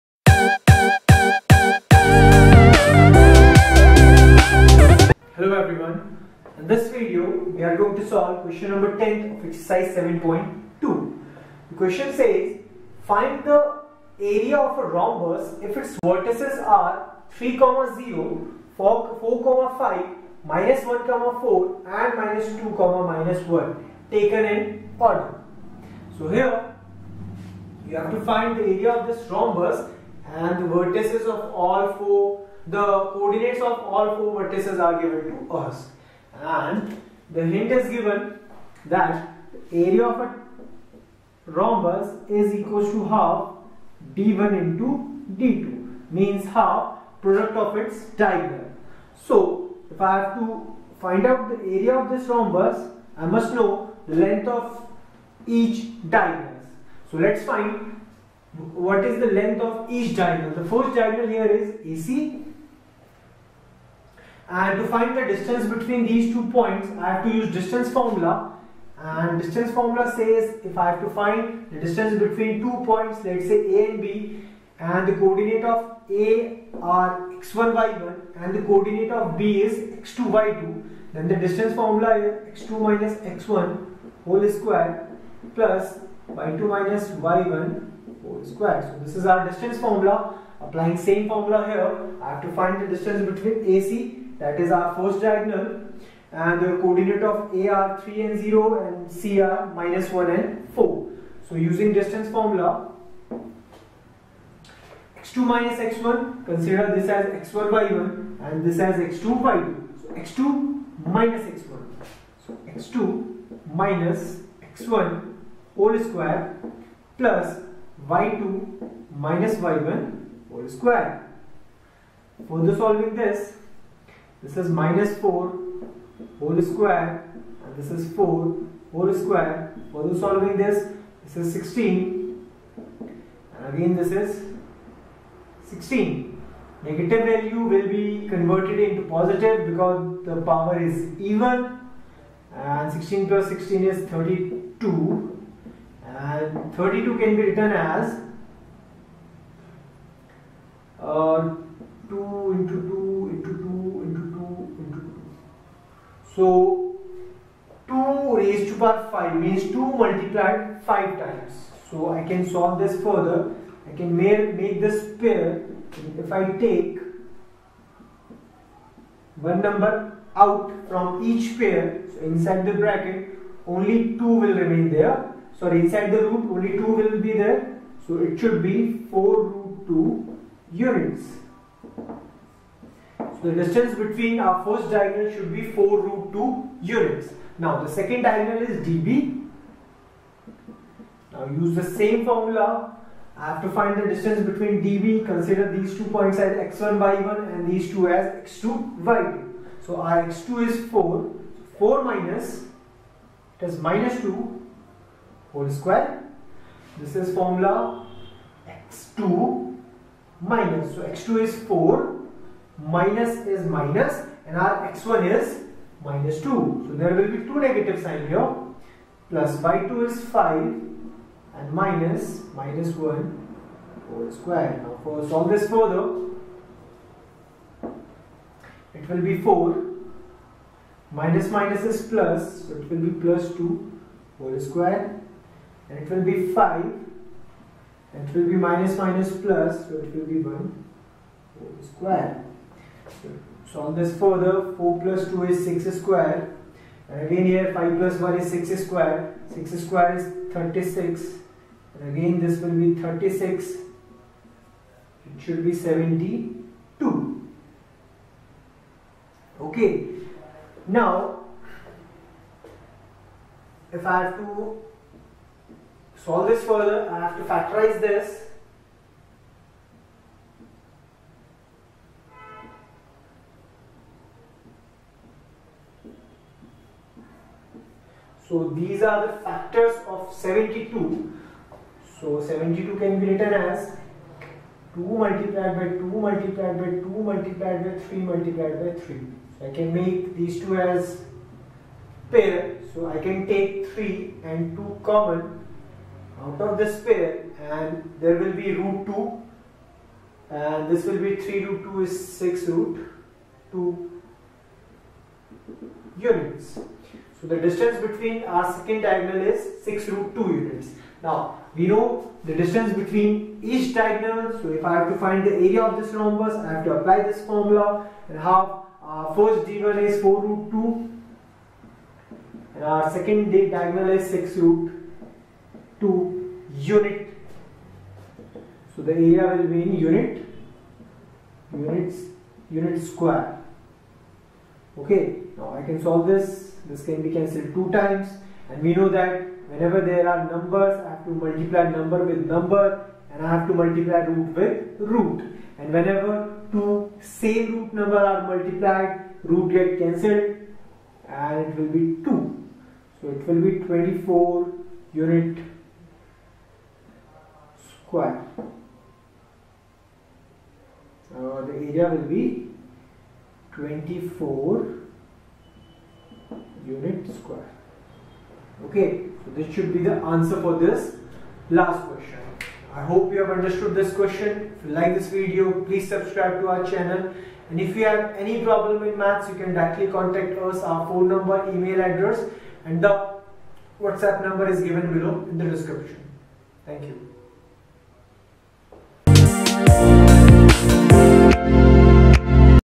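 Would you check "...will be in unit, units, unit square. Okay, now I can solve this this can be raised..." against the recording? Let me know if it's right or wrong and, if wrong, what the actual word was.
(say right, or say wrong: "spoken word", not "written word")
wrong: "cancelled", not "raised".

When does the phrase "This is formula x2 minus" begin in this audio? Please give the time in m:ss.
3:26.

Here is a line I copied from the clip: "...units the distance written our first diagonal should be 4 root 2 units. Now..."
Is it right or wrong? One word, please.
wrong.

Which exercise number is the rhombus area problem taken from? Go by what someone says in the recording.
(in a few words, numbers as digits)
7.2.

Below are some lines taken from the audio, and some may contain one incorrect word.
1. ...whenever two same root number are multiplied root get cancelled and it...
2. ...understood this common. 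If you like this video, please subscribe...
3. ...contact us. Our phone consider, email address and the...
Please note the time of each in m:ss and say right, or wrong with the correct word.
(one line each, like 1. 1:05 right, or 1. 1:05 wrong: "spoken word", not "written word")
1. 5:45 right
2. 6:13 wrong: "question", not "common"
3. 6:20 wrong: "number", not "consider".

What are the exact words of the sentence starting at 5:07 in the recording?
So the distance between our second diagonal is 6 root 2 units.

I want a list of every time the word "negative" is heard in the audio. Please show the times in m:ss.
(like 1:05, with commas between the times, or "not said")
2:16, 3:37.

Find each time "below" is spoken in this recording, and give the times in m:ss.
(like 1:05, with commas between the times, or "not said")
6:25.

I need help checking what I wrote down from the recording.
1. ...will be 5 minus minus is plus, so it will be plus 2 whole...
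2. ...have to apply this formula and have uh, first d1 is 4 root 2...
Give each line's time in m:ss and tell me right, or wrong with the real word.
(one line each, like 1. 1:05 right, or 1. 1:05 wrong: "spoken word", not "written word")
1. 3:49 wrong: "4", not "5"
2. 5:16 right.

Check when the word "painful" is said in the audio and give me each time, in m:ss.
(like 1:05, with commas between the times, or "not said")
not said.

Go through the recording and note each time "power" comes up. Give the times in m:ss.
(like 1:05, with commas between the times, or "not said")
2:20, 2:38.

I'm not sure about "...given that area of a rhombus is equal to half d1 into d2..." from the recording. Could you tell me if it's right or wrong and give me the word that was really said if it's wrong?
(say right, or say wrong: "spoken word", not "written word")
right.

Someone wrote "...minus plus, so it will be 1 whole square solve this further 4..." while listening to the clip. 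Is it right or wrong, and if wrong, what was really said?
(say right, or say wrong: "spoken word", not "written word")
right.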